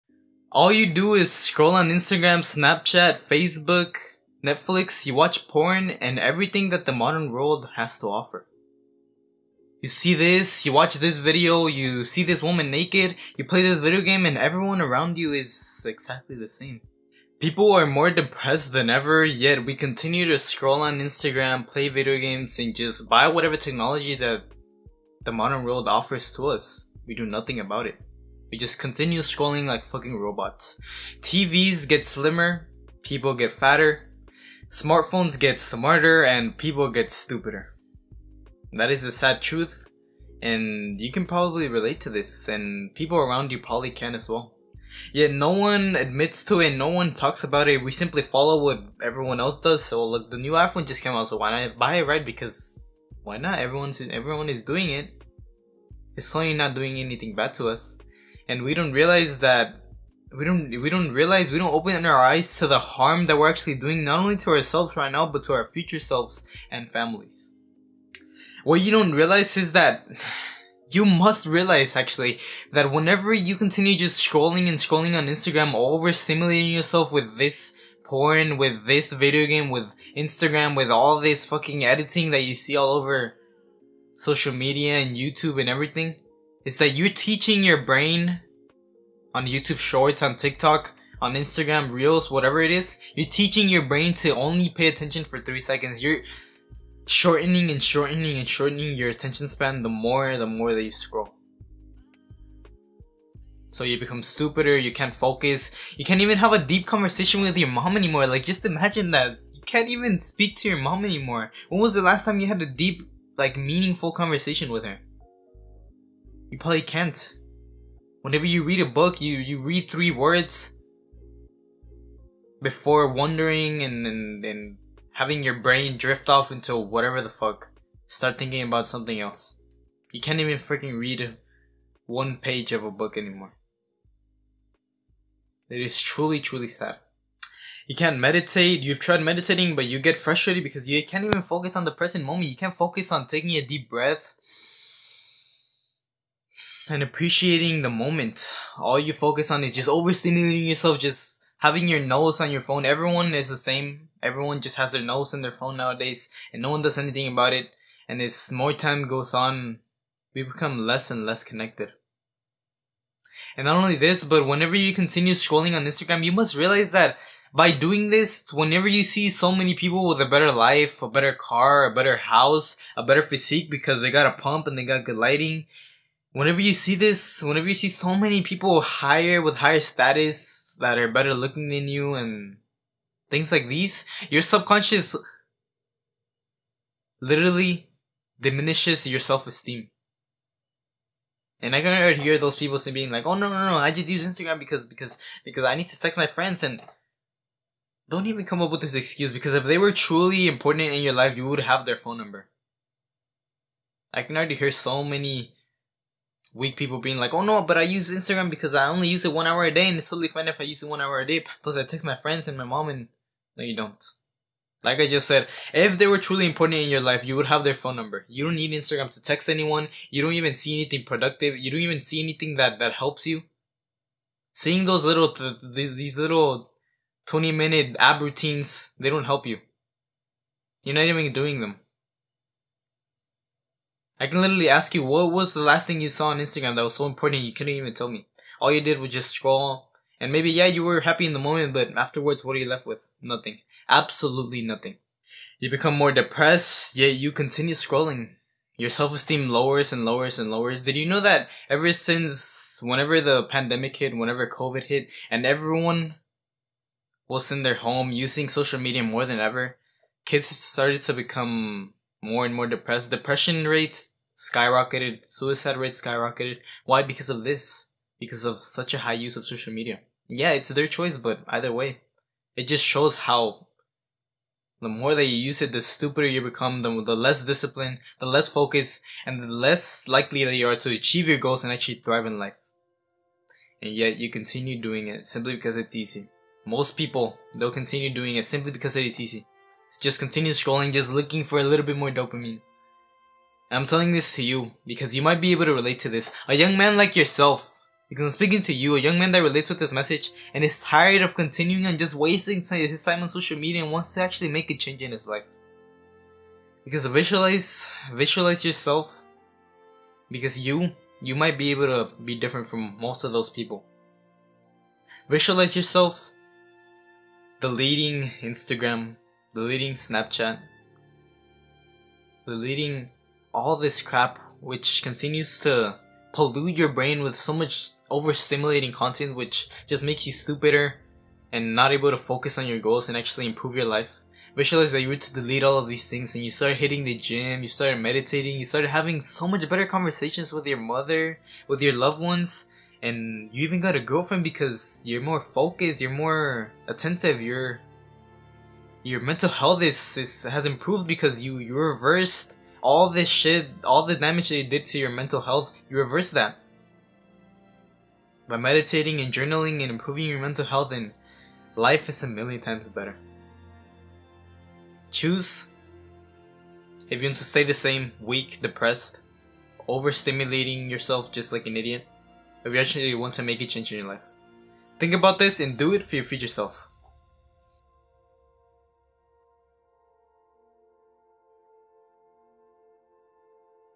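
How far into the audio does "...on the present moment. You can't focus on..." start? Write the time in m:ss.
2:21.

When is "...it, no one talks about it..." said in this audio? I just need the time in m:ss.
0:46.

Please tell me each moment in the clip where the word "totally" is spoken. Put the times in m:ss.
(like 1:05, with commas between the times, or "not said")
3:30.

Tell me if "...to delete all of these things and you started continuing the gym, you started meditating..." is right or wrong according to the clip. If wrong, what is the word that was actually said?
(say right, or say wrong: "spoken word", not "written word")
wrong: "hitting", not "continuing".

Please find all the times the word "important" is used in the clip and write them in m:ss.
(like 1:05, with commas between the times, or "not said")
3:20, 3:36, 3:57.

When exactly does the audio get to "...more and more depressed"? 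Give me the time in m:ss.
4:22.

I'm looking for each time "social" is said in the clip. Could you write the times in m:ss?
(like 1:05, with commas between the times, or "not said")
1:24, 4:18, 4:29, 5:03.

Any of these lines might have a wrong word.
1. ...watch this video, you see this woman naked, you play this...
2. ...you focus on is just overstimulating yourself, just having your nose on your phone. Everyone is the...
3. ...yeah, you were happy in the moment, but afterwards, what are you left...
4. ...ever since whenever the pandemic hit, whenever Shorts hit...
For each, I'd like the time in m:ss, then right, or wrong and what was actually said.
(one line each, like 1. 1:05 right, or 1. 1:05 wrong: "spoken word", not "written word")
1. 0:10 right
2. 2:28 right
3. 4:00 right
4. 4:11 wrong: "COVID", not "Shorts".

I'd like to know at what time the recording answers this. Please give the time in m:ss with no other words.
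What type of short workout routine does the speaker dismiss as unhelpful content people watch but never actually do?
3:47.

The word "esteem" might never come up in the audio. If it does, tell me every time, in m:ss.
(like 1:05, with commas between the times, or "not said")
3:09, 4:09.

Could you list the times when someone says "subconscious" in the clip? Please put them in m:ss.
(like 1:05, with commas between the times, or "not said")
3:04.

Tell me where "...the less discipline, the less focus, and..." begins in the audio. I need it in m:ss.
4:37.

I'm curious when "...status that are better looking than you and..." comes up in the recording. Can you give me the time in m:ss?
2:59.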